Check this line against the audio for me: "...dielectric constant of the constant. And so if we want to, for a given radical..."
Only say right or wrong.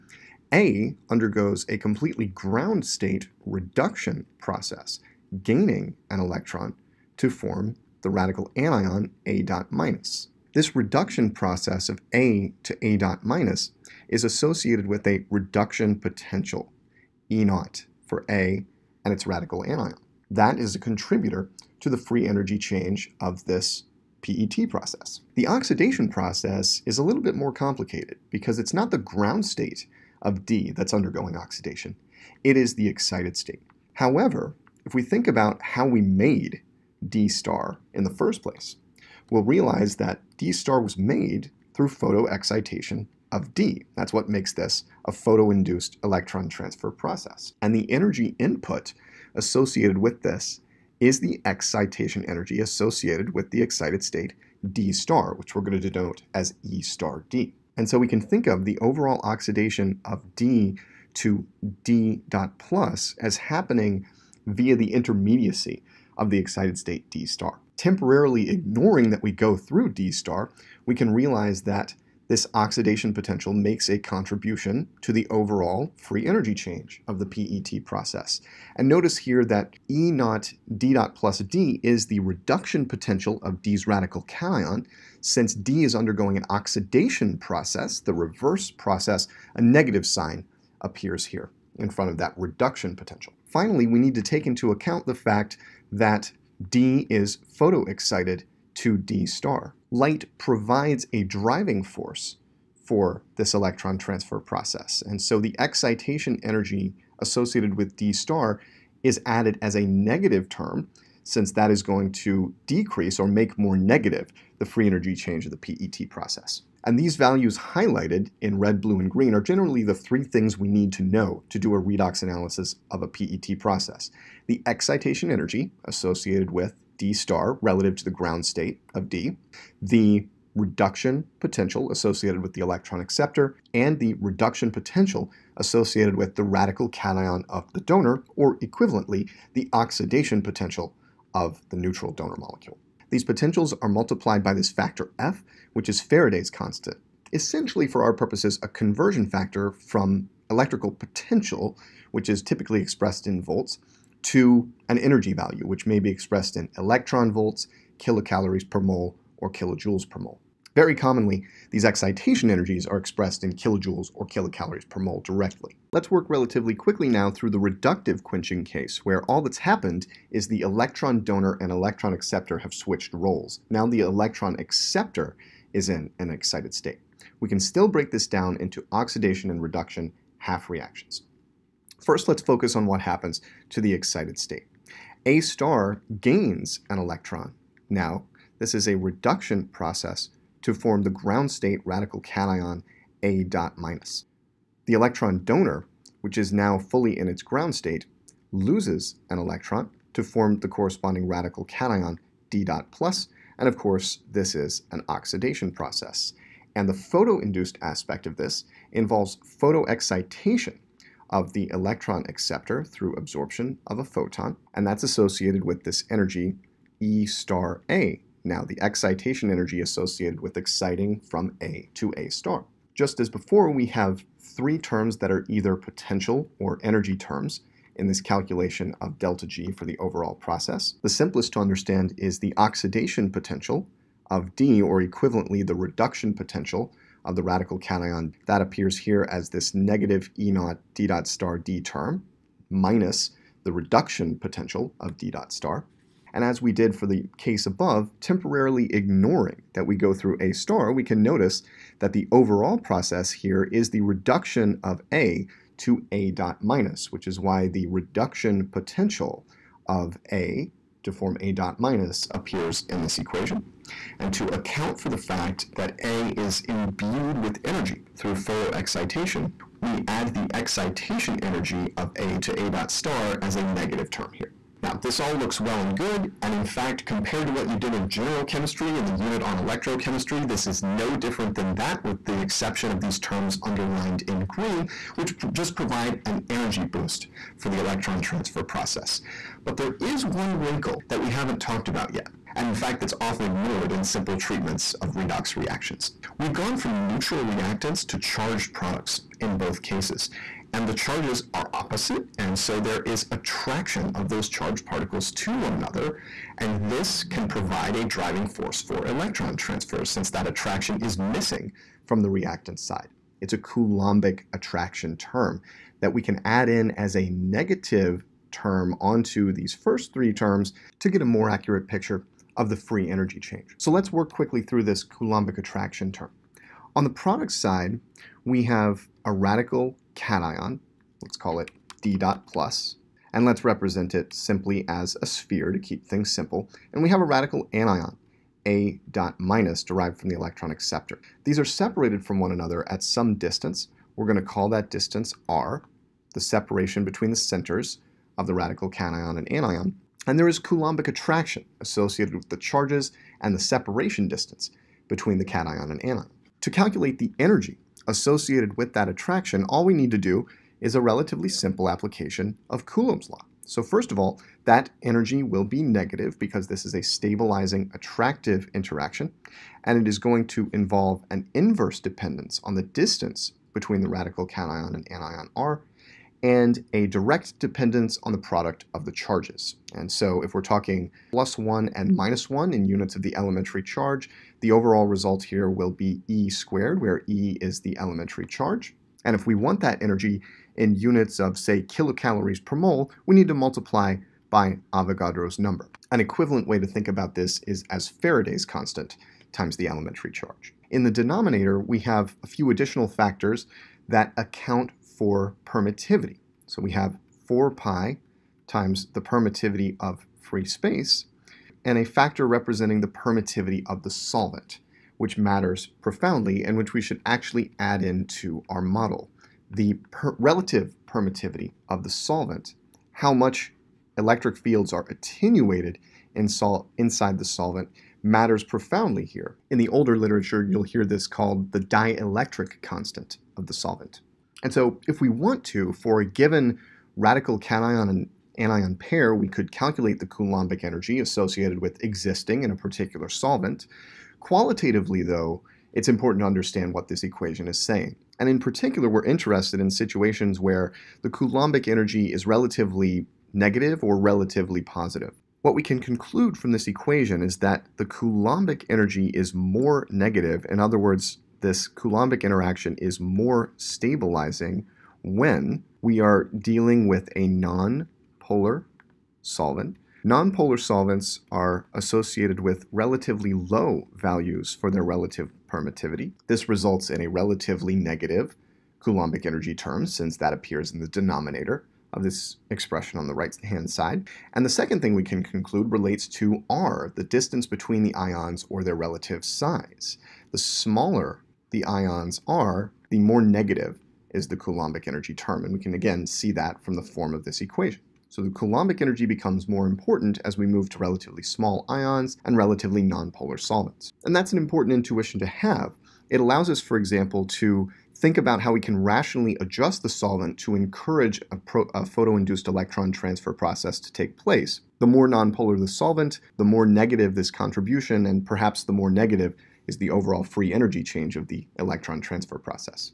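wrong.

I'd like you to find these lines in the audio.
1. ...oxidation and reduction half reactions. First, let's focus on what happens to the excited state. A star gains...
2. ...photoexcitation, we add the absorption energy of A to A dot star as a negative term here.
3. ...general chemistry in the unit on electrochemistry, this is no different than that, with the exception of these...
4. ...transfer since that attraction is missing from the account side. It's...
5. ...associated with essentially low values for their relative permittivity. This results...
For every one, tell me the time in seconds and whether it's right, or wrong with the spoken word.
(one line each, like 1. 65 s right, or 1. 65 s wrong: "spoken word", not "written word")
1. 178 s right
2. 268 s wrong: "excitation", not "absorption"
3. 278 s right
4. 309 s wrong: "reactant", not "account"
5. 471 s wrong: "relatively", not "essentially".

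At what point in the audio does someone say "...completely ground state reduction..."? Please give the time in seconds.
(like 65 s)
1 s.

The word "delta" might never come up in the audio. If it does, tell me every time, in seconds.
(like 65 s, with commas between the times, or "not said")
229 s.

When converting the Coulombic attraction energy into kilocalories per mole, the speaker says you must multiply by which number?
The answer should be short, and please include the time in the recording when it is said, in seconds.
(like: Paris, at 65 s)
Avogadro's number, at 394 s.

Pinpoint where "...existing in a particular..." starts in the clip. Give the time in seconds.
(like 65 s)
442 s.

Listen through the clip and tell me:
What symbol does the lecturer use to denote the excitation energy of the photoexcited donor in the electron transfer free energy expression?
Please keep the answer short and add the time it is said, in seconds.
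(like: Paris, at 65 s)
E star D, at 56 s.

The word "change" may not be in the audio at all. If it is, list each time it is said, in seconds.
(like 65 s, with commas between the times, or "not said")
22 s, 76 s, 115 s, 323 s, 521 s.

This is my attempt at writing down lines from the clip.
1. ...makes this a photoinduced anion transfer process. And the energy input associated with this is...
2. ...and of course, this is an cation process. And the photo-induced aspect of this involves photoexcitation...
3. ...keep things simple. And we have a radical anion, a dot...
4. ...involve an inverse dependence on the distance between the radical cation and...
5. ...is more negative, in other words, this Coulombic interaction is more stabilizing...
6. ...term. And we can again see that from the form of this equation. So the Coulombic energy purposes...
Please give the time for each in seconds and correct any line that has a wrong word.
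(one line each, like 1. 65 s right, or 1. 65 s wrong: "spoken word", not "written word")
1. 44 s wrong: "electron", not "anion"
2. 203 s wrong: "oxidation", not "cation"
3. 335 s right
4. 370 s right
5. 459 s right
6. 495 s wrong: "becomes", not "purposes".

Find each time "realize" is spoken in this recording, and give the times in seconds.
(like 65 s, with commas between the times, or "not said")
39 s, 71 s.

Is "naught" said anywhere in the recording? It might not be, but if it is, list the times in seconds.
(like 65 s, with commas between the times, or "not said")
17 s, 80 s, 240 s.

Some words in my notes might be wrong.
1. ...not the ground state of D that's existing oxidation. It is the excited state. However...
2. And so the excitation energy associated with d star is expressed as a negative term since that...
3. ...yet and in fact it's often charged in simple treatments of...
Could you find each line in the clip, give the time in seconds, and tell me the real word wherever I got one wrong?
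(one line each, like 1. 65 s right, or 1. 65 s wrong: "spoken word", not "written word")
1. 28 s wrong: "undergoing", not "existing"
2. 105 s wrong: "added", not "expressed"
3. 292 s wrong: "ignored", not "charged".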